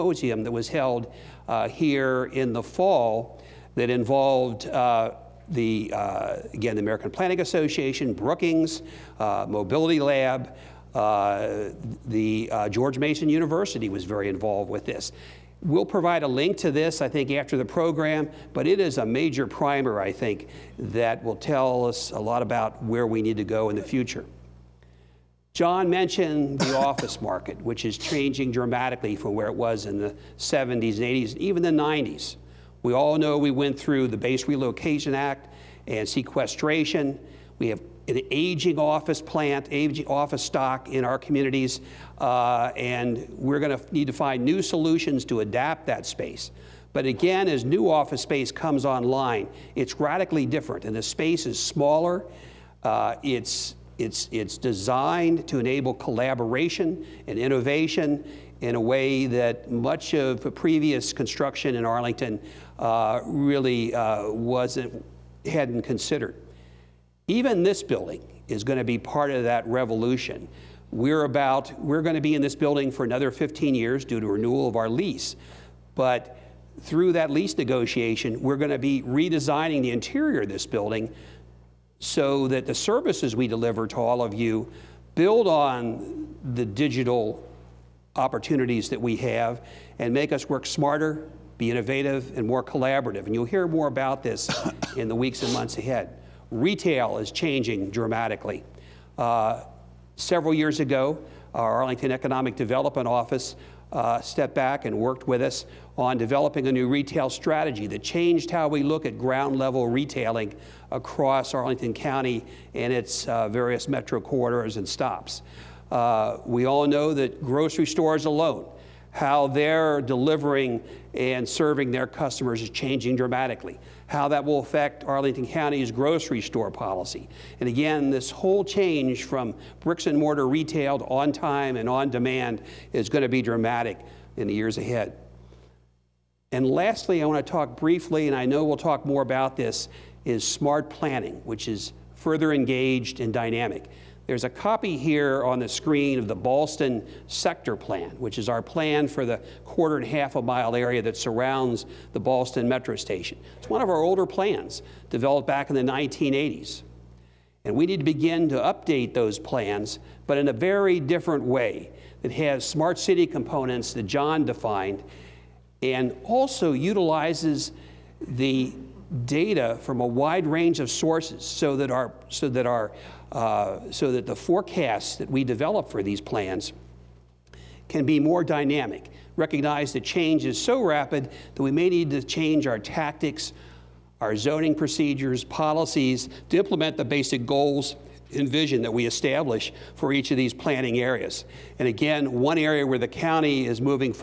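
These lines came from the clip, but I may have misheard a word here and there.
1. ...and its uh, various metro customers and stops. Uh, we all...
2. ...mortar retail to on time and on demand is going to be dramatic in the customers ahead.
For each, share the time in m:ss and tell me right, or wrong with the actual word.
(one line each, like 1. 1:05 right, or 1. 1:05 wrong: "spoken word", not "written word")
1. 1:52 wrong: "corridors", not "customers"
2. 2:10 wrong: "years", not "customers".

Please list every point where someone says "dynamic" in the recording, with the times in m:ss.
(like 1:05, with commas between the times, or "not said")
2:23, 2:58.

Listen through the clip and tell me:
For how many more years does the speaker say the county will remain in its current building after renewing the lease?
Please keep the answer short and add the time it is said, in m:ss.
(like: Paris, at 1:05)
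15 years, at 1:13.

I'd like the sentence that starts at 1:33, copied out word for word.
And you'll hear more about this in the weeks and months ahead.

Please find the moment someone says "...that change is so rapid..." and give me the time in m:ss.
2:59.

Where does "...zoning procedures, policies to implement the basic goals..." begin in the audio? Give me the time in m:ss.
3:04.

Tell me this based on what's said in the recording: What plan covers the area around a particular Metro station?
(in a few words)
Ballston Sector Plan.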